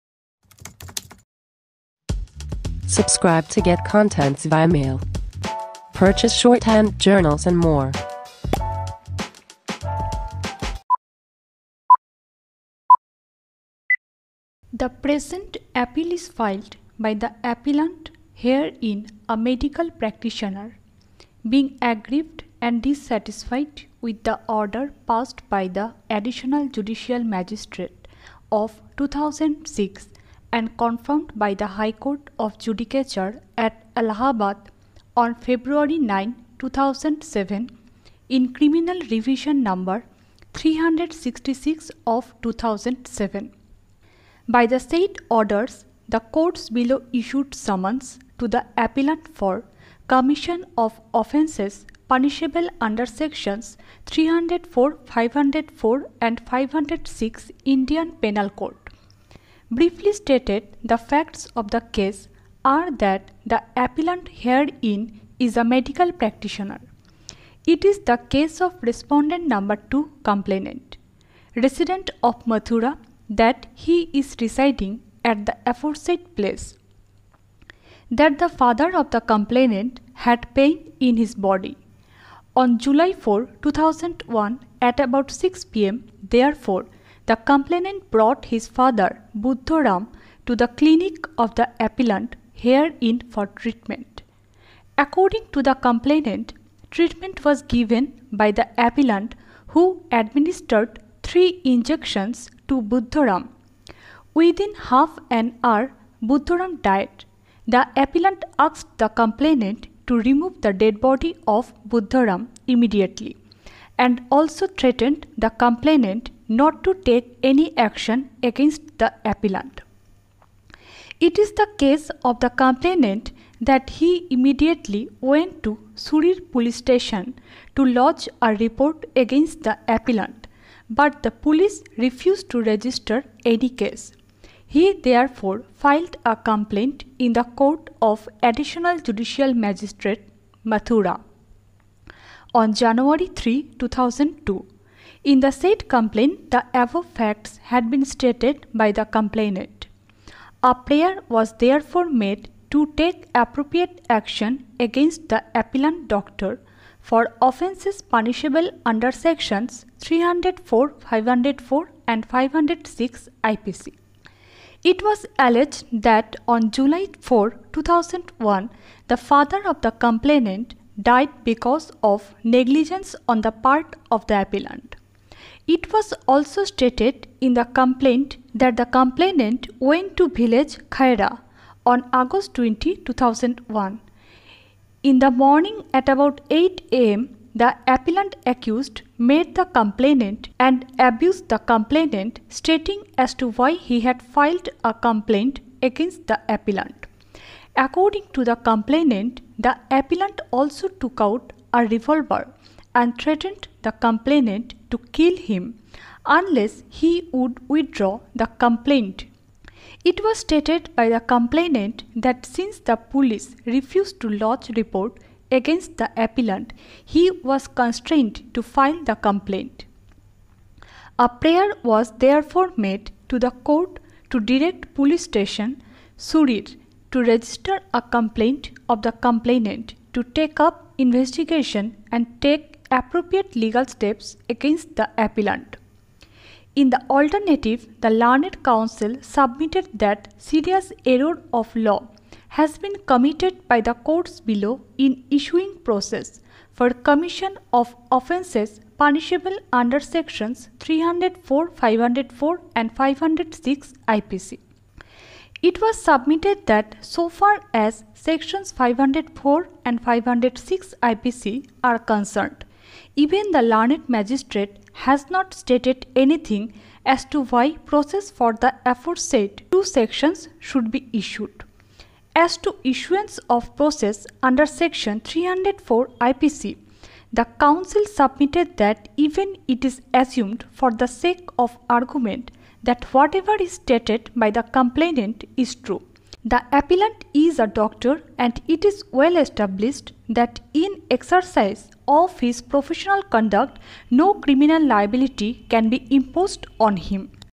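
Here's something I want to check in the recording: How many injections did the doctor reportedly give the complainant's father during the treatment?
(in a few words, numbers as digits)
3.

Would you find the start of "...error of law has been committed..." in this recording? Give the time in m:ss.
4:01.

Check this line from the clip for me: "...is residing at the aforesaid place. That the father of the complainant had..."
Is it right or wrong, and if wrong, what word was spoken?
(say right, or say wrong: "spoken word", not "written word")
right.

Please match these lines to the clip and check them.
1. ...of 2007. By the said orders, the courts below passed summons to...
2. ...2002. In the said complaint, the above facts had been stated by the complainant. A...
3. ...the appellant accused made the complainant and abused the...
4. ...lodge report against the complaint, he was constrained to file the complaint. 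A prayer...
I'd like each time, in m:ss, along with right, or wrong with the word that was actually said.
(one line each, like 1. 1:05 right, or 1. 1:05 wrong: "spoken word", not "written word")
1. 0:42 wrong: "issued", not "passed"
2. 2:23 right
3. 3:07 right
4. 3:34 wrong: "appellant", not "complaint".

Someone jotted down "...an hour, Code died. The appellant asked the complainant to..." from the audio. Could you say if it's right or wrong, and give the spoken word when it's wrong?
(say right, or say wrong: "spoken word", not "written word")
wrong: "Buddharam", not "Code".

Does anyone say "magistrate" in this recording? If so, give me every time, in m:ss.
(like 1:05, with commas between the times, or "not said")
0:27, 2:19, 4:24.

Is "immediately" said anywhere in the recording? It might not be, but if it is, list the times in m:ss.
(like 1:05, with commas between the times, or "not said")
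1:52, 2:04.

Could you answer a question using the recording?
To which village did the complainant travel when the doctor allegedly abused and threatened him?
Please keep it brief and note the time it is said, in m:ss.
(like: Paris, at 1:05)
Khaira, at 3:00.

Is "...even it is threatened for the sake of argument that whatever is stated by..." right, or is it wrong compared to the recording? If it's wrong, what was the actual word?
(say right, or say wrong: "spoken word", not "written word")
wrong: "assumed", not "threatened".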